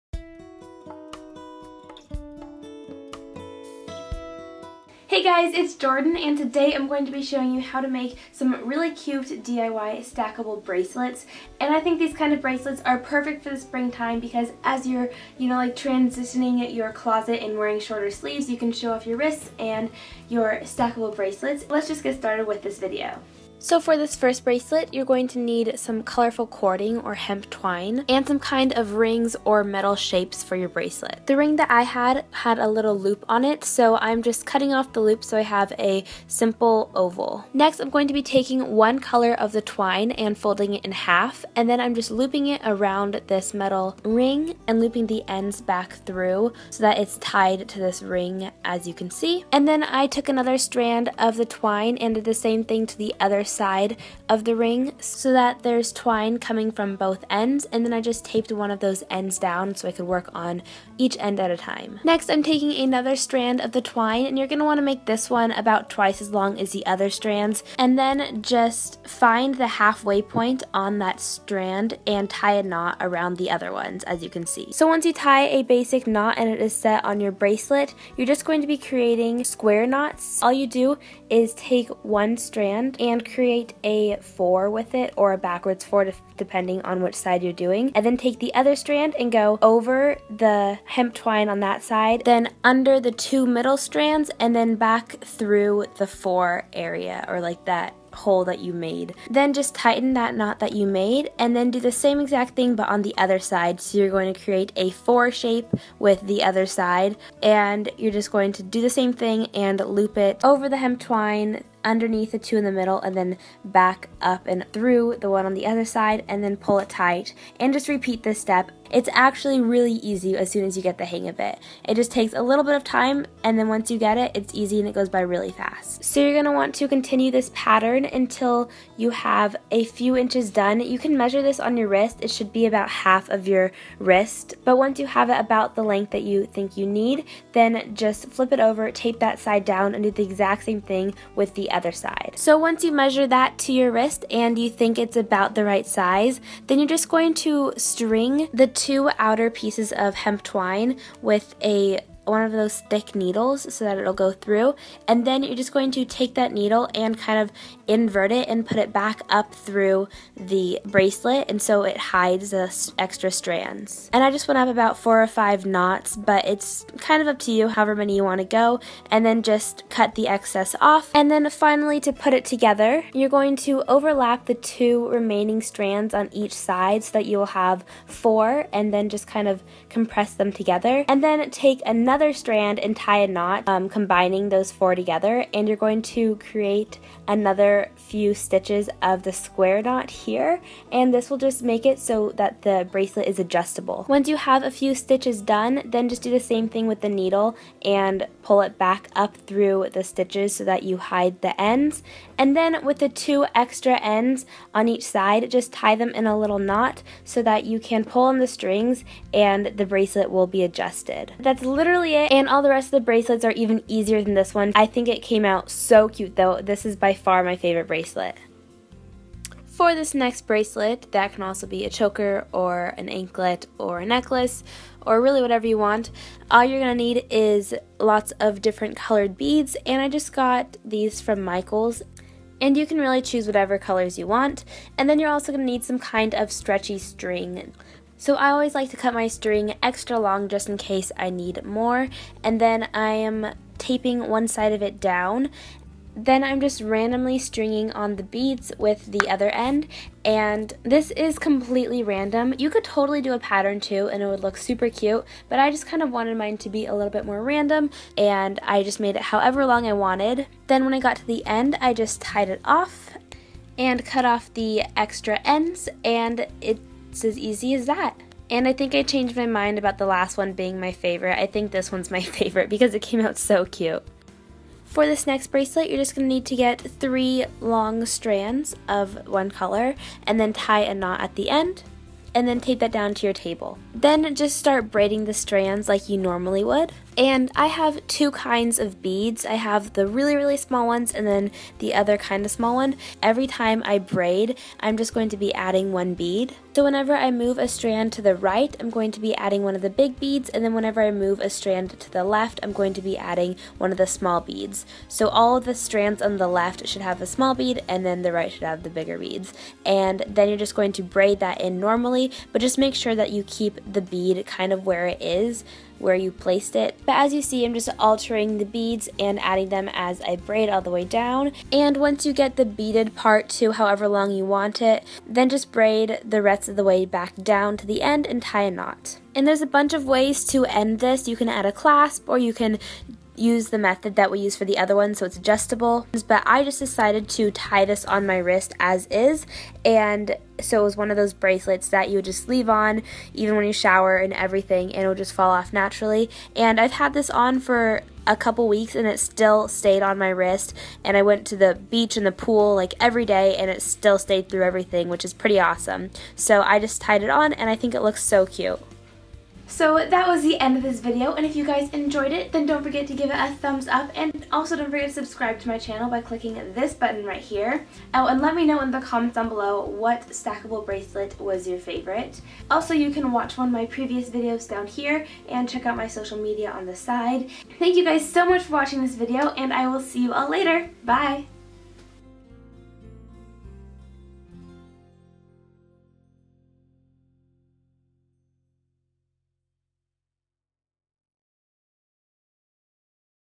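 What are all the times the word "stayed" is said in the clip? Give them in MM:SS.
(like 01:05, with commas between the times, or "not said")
05:49, 05:54.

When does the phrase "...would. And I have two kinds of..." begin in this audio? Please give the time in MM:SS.
04:46.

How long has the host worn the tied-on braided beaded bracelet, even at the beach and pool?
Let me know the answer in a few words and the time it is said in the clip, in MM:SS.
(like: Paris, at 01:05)
A couple weeks, at 05:48.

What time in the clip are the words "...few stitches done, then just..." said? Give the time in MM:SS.
03:14.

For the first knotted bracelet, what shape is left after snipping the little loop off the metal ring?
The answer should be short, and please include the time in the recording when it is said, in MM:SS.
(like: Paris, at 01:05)
Oval, at 00:36.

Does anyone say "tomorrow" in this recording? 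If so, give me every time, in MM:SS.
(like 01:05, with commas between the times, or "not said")
not said.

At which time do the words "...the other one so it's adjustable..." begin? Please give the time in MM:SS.
05:34.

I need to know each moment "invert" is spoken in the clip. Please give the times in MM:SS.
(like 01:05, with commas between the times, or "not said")
02:37.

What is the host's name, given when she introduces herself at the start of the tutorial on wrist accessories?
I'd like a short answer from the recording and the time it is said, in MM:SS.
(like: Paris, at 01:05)
Jordan, at 00:05.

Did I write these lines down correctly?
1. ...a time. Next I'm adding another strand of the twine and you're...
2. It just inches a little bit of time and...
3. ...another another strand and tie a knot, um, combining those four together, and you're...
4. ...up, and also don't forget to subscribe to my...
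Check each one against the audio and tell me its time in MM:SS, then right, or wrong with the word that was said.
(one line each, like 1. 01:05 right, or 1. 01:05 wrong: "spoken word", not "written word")
1. 01:01 wrong: "taking", not "adding"
2. 02:01 wrong: "takes", not "inches"
3. 03:01 right
4. 06:03 right.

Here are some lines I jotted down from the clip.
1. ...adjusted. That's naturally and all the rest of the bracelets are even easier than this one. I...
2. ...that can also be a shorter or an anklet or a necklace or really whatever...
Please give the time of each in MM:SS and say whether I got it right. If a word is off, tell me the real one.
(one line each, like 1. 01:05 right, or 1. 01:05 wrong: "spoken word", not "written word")
1. 03:30 wrong: "literally", not "naturally"
2. 03:41 wrong: "choker", not "shorter".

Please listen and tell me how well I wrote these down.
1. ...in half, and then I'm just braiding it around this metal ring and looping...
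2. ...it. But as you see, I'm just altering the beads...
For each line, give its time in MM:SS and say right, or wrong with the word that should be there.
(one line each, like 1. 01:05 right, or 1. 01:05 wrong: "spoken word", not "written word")
1. 00:40 wrong: "looping", not "braiding"
2. 05:16 right.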